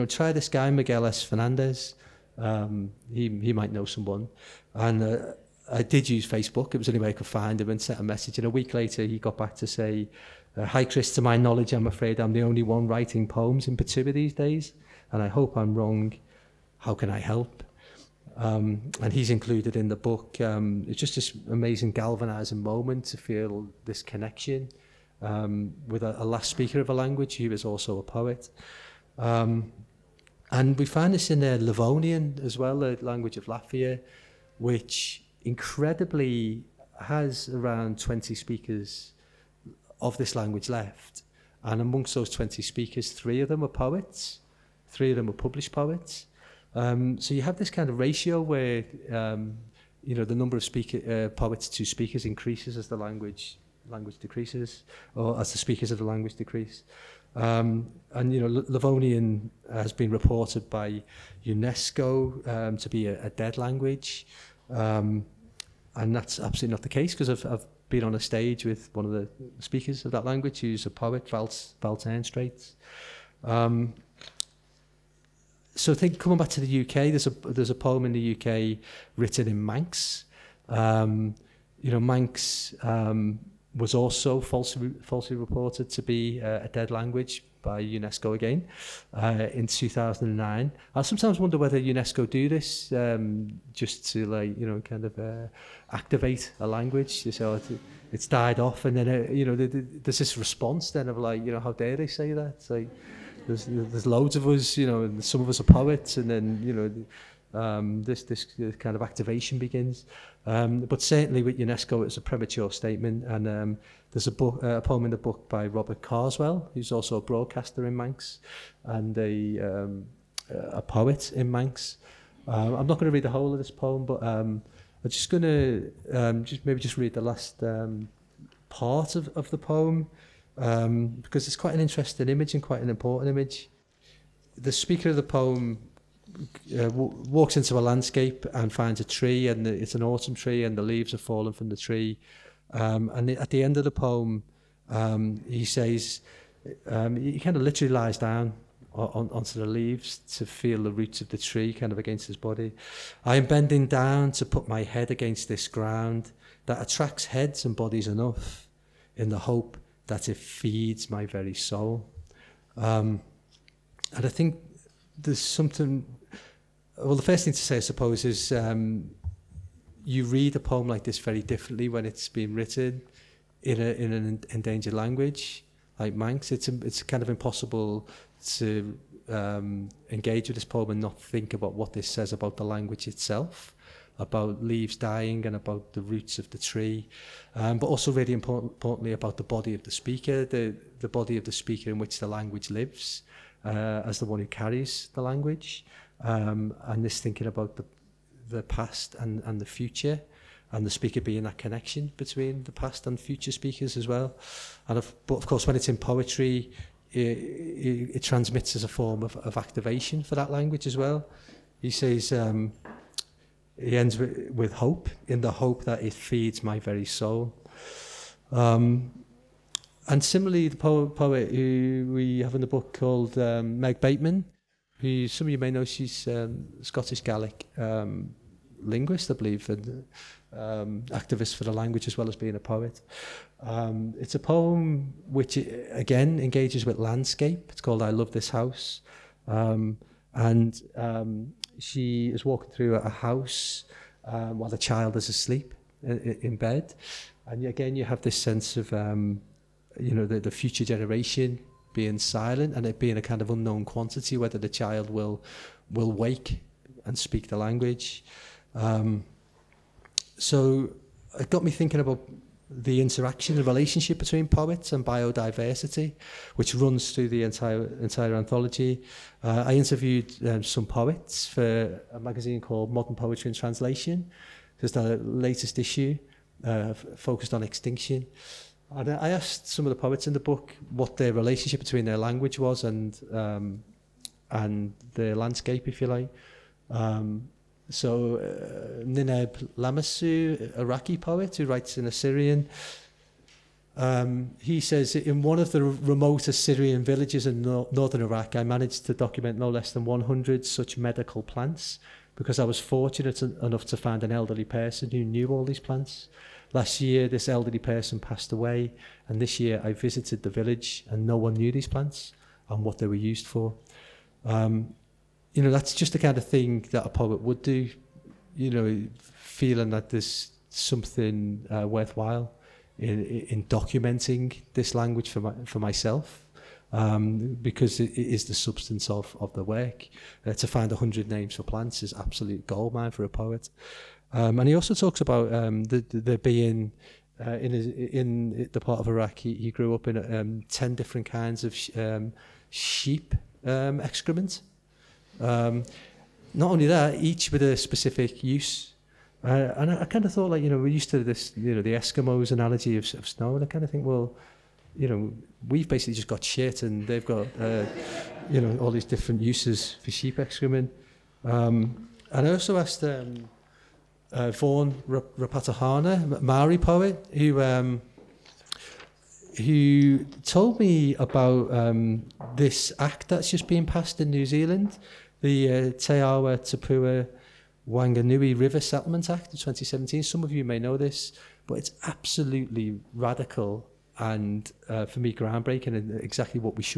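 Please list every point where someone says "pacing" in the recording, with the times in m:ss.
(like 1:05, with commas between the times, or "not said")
not said.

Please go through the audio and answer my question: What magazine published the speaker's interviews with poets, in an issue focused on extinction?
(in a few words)
Modern Poetry and Translation.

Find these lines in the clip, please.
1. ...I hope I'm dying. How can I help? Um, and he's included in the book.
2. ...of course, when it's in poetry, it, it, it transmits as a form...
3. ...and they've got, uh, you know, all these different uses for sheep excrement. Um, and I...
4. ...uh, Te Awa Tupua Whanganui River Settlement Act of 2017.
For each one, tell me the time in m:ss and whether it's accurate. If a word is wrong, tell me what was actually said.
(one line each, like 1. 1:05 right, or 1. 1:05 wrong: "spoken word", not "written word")
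1. 0:15 wrong: "wrong", not "dying"
2. 3:25 right
3. 5:56 right
4. 6:15 right.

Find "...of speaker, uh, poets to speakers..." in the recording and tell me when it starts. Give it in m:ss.
0:50.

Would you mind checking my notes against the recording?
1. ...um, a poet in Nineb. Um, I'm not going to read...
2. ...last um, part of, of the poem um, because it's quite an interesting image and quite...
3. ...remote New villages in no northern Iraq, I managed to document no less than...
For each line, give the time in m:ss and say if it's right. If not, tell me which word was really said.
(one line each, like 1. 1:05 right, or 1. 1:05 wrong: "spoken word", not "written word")
1. 1:59 wrong: "Manx", not "Nineb"
2. 2:07 right
3. 4:55 wrong: "Assyrian", not "New".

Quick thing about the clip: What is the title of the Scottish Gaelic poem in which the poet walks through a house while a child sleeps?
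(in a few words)
I Love This House.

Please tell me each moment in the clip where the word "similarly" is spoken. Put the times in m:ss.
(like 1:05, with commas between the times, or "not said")
3:40.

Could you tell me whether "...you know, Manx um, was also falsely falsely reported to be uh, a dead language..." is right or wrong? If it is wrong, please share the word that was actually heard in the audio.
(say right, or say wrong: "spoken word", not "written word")
right.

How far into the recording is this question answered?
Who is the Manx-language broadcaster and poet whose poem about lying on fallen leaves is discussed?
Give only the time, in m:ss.
1:55.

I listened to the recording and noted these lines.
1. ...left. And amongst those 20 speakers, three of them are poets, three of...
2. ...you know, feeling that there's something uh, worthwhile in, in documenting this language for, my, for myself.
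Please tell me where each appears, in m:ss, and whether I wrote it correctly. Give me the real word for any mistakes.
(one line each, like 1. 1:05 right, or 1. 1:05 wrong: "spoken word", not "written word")
1. 0:40 right
2. 5:18 right.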